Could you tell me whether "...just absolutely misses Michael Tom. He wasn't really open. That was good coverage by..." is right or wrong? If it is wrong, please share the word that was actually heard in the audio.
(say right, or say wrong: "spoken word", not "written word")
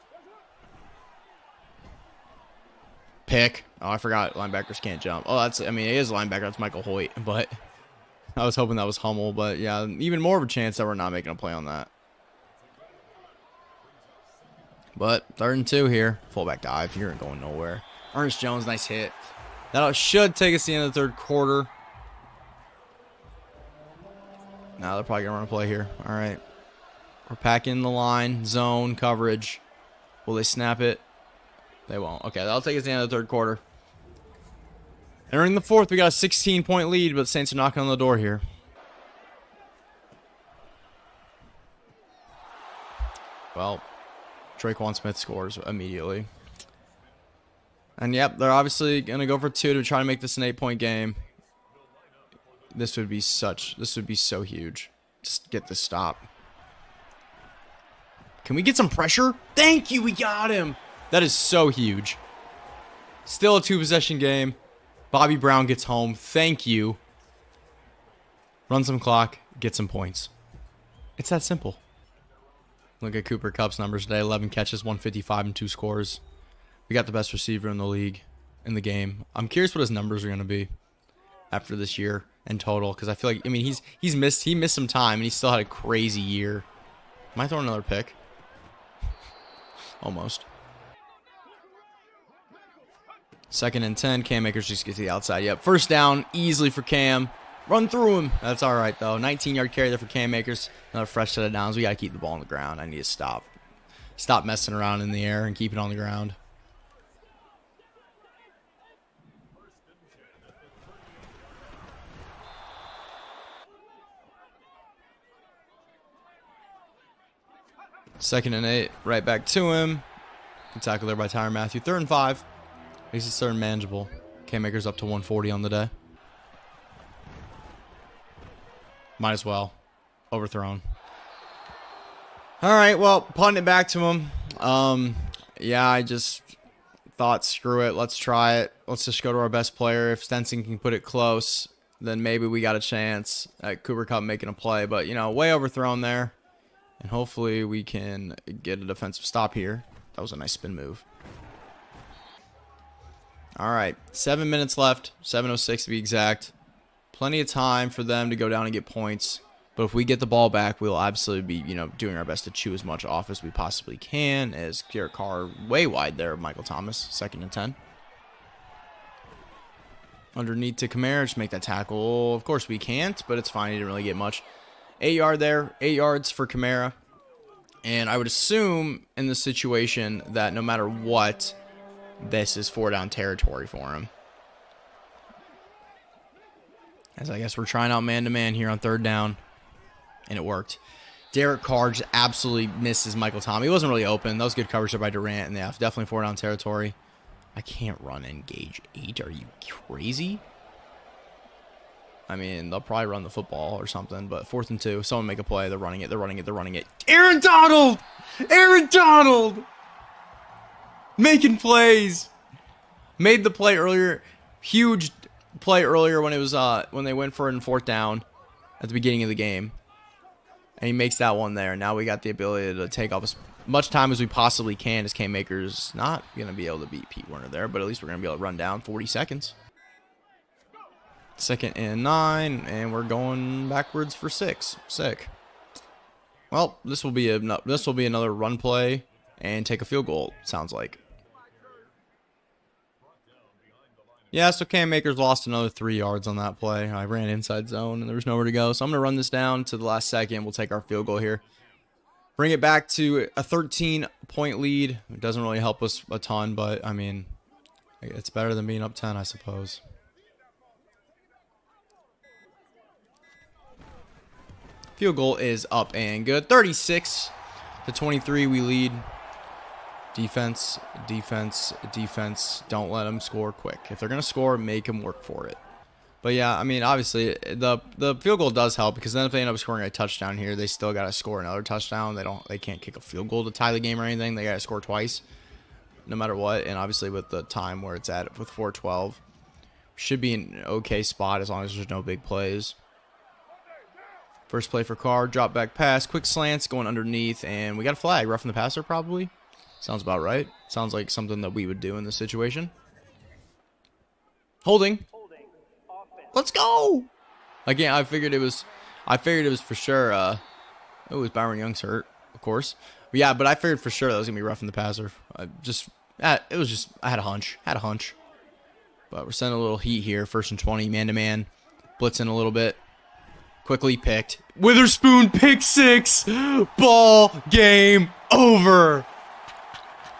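right.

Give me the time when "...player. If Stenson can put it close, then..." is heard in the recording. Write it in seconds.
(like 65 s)
139 s.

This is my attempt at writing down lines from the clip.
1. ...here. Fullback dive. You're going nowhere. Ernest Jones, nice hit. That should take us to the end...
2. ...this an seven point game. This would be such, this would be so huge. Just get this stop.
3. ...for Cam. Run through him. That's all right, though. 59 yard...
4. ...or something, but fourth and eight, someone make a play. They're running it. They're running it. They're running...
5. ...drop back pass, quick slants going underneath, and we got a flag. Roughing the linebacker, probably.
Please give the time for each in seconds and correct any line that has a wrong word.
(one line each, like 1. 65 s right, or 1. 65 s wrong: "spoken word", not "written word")
1. 15 s right
2. 50 s wrong: "eight", not "seven"
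3. 96 s wrong: "19", not "59"
4. 203 s wrong: "two", not "eight"
5. 295 s wrong: "passer", not "linebacker".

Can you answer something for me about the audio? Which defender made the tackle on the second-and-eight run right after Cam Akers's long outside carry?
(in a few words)
Tyrann Mathieu.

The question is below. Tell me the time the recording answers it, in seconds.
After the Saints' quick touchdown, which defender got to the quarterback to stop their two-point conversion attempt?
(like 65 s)
65 s.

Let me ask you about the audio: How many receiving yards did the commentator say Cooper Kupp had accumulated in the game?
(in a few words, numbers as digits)
155.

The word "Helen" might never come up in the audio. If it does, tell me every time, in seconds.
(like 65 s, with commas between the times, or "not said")
not said.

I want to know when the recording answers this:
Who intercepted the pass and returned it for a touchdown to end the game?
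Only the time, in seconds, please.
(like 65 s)
324 s.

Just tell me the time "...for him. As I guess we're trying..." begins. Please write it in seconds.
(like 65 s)
183 s.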